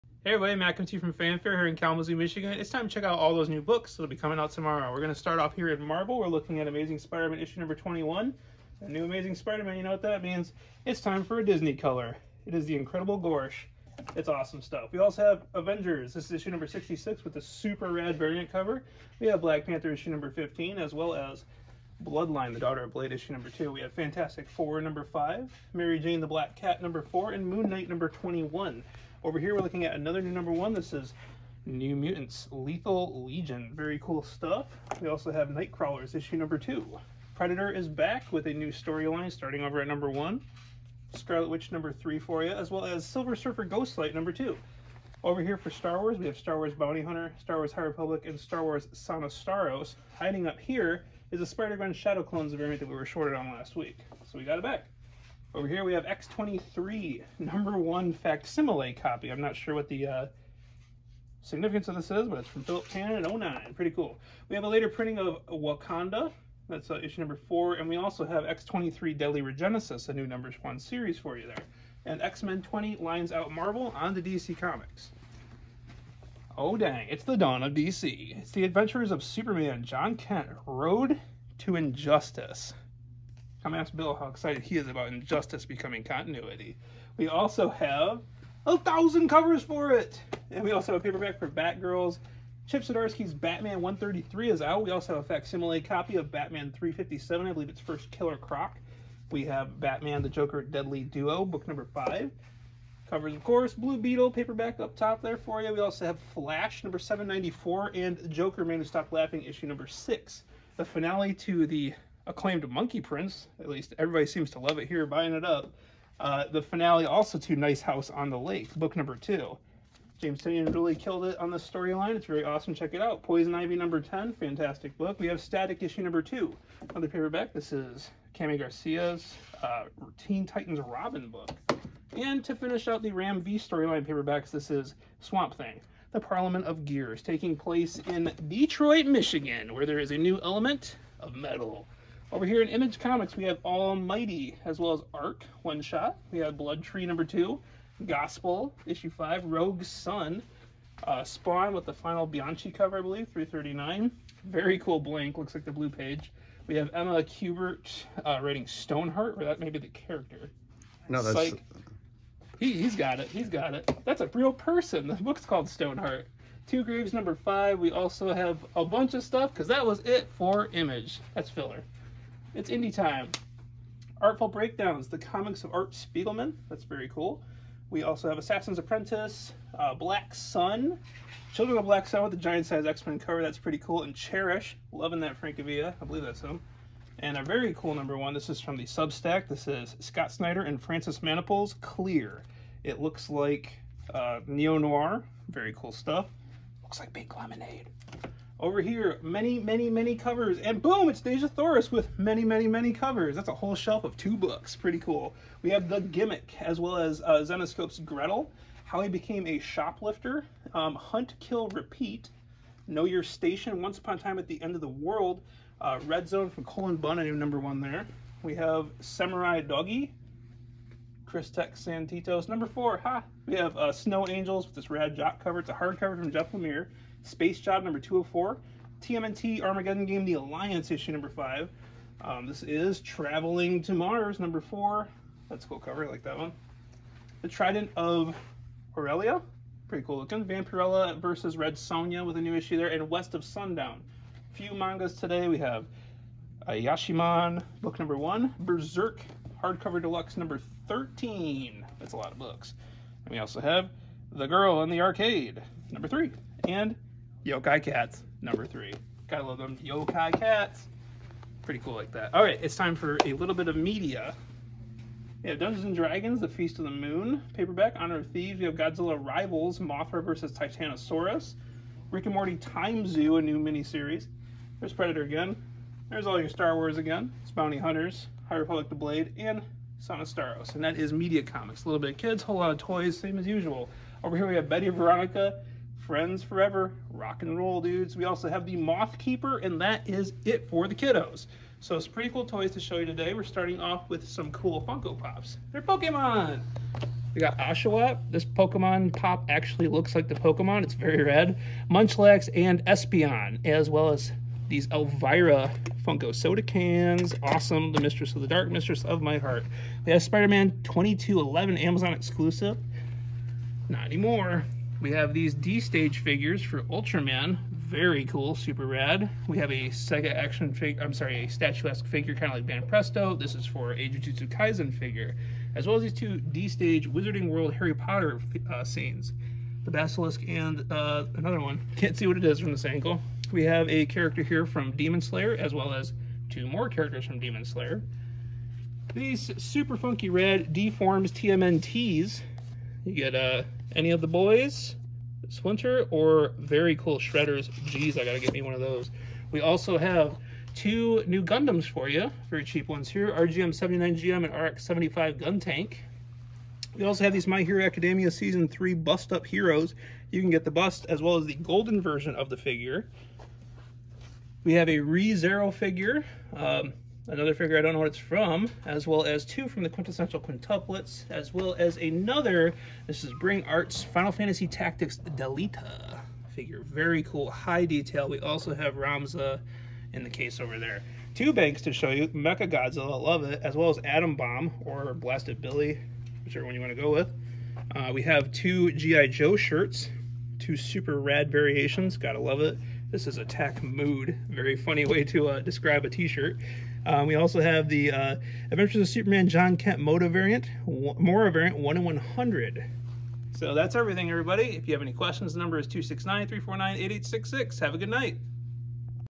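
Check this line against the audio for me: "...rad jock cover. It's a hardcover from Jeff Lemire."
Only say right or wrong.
right.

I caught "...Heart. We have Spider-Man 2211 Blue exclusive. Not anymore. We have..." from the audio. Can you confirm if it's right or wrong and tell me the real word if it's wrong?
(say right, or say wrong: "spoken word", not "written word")
wrong: "Amazon", not "Blue".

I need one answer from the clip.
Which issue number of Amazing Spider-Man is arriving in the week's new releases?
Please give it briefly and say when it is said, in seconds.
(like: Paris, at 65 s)
21, at 7 s.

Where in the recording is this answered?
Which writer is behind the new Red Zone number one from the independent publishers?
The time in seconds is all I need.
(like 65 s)
216 s.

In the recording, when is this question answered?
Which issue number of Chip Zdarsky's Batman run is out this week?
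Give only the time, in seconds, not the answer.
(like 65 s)
93 s.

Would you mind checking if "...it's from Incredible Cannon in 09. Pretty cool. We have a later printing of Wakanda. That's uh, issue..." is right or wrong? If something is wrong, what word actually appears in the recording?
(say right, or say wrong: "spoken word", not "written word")
wrong: "Philip", not "Incredible".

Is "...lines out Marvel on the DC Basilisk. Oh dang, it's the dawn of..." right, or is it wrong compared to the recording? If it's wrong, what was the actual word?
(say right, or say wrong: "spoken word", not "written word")
wrong: "Comics", not "Basilisk".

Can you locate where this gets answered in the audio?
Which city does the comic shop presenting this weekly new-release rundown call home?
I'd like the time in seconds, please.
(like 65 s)
1 s.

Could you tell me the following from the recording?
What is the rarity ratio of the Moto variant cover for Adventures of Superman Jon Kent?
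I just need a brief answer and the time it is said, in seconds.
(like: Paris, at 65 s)
1 in 100, at 401 s.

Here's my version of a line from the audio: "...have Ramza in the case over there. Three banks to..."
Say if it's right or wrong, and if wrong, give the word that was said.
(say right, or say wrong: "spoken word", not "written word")
wrong: "Two", not "Three".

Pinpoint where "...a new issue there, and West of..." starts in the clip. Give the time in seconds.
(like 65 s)
242 s.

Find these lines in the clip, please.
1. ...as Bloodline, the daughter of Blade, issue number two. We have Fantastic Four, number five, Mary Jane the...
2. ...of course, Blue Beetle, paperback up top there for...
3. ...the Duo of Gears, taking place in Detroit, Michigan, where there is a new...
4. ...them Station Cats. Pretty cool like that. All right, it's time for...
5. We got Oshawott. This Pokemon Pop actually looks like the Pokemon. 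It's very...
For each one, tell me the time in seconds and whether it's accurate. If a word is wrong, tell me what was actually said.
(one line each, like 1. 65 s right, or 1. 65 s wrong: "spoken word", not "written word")
1. 21 s right
2. 103 s right
3. 136 s wrong: "Parliament", not "Duo"
4. 259 s wrong: "Yokai", not "Station"
5. 297 s right.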